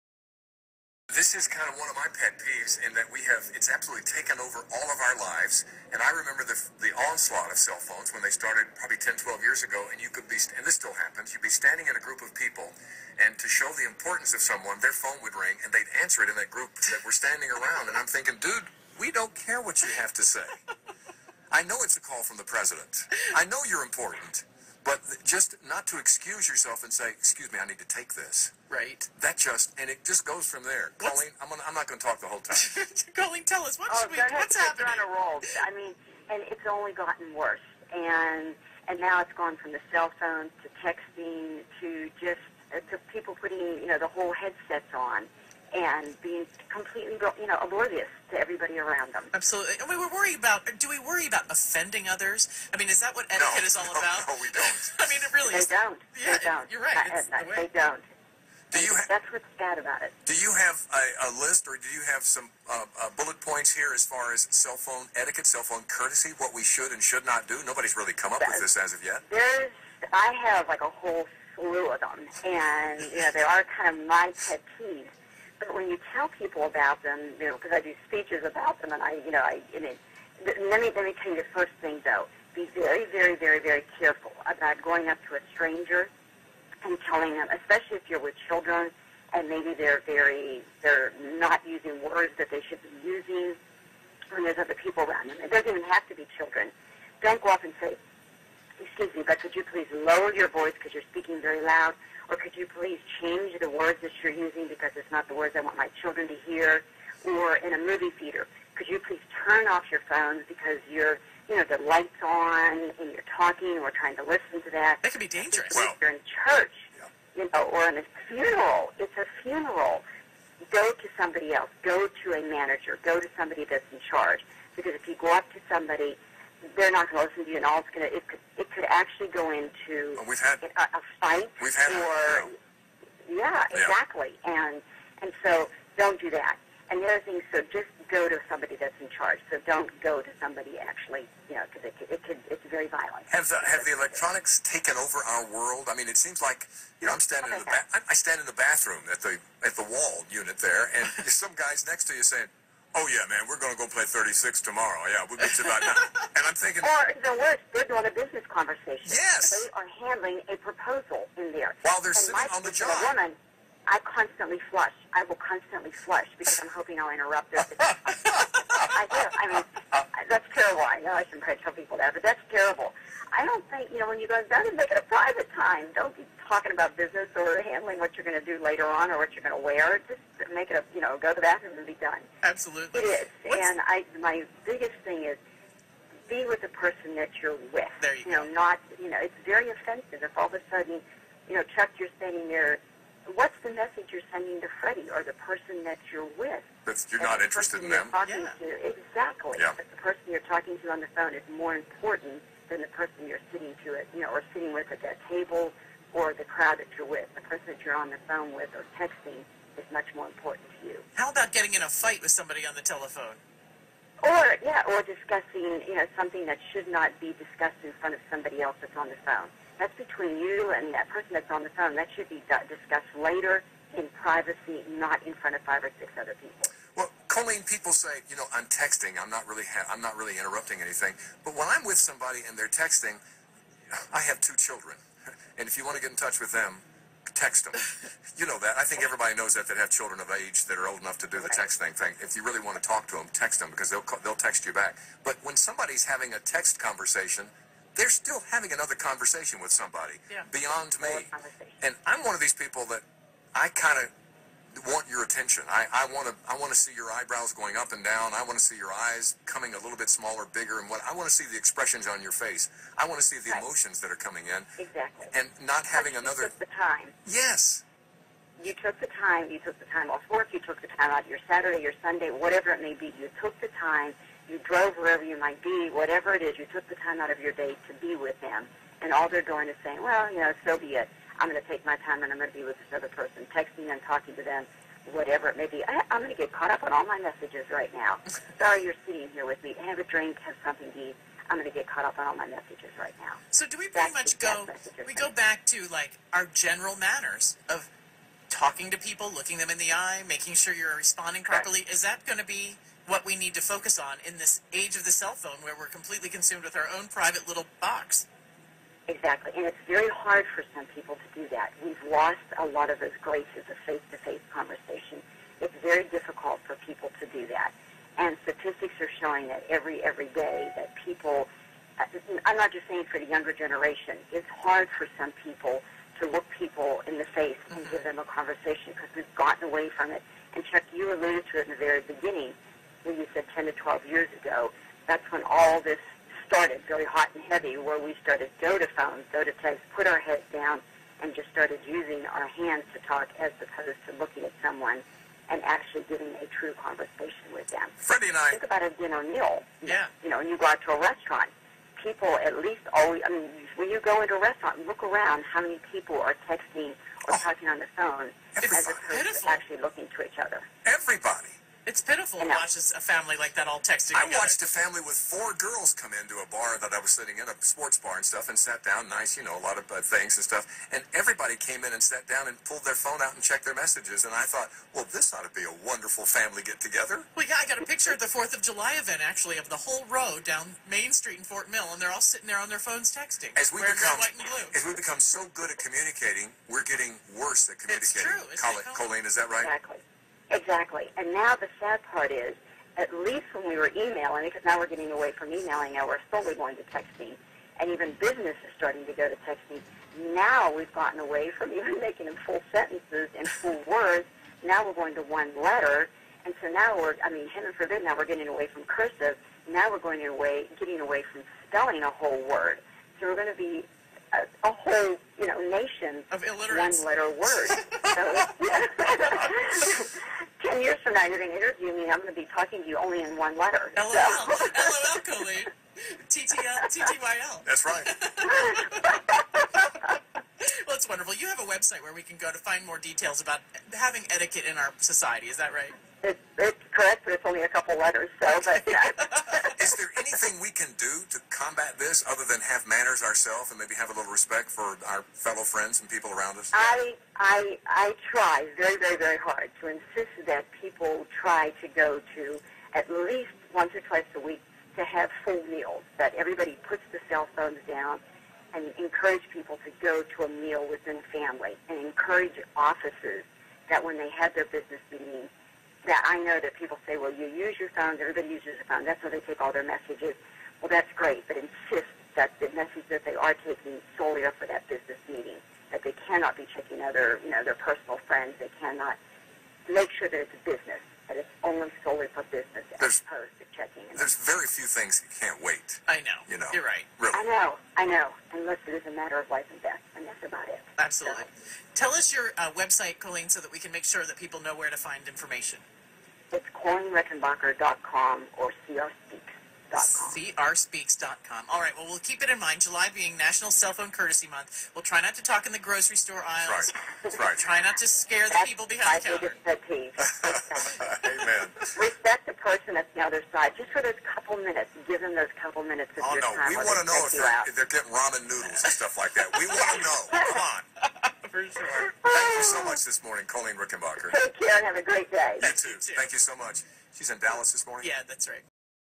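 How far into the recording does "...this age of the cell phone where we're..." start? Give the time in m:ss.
5:04.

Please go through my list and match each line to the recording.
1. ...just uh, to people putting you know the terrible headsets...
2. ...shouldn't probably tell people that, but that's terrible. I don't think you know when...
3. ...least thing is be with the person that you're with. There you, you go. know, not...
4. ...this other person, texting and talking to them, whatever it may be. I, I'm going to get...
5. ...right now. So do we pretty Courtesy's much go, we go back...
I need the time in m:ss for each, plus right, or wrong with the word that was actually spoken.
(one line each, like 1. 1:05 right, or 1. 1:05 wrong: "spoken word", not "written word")
1. 0:42 wrong: "whole", not "terrible"
2. 2:51 right
3. 3:04 wrong: "biggest", not "least"
4. 4:42 right
5. 4:52 wrong: "That", not "Courtesy".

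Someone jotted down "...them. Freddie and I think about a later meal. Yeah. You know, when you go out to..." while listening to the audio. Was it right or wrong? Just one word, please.
wrong.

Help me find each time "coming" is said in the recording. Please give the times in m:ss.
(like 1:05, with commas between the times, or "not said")
4:19, 4:24.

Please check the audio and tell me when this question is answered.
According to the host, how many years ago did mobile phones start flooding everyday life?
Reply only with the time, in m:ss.
0:08.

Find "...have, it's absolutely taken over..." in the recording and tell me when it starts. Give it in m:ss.
0:03.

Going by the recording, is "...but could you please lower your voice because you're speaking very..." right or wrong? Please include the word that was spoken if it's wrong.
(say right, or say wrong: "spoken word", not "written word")
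right.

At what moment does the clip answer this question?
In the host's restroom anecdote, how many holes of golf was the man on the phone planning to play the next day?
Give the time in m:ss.
2:34.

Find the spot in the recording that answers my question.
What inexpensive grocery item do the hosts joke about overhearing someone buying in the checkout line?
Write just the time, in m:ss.
8:38.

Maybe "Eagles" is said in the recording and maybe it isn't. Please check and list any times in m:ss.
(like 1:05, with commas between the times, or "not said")
not said.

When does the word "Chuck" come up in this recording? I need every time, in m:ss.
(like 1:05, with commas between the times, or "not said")
3:11, 5:30.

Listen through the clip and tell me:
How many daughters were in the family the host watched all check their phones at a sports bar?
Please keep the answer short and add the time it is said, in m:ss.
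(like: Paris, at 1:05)
4, at 6:05.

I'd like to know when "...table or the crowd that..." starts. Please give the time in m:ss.
3:25.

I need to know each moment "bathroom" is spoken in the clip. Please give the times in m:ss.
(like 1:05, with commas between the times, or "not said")
2:28, 3:01.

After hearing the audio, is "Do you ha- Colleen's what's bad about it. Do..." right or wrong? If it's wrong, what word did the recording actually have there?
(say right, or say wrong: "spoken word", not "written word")
wrong: "That", not "Colleen".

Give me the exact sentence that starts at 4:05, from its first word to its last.
But when somebody's having a text conversation, they're still having another conversation with somebody yeah.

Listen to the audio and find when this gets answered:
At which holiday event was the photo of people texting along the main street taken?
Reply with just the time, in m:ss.
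6:18.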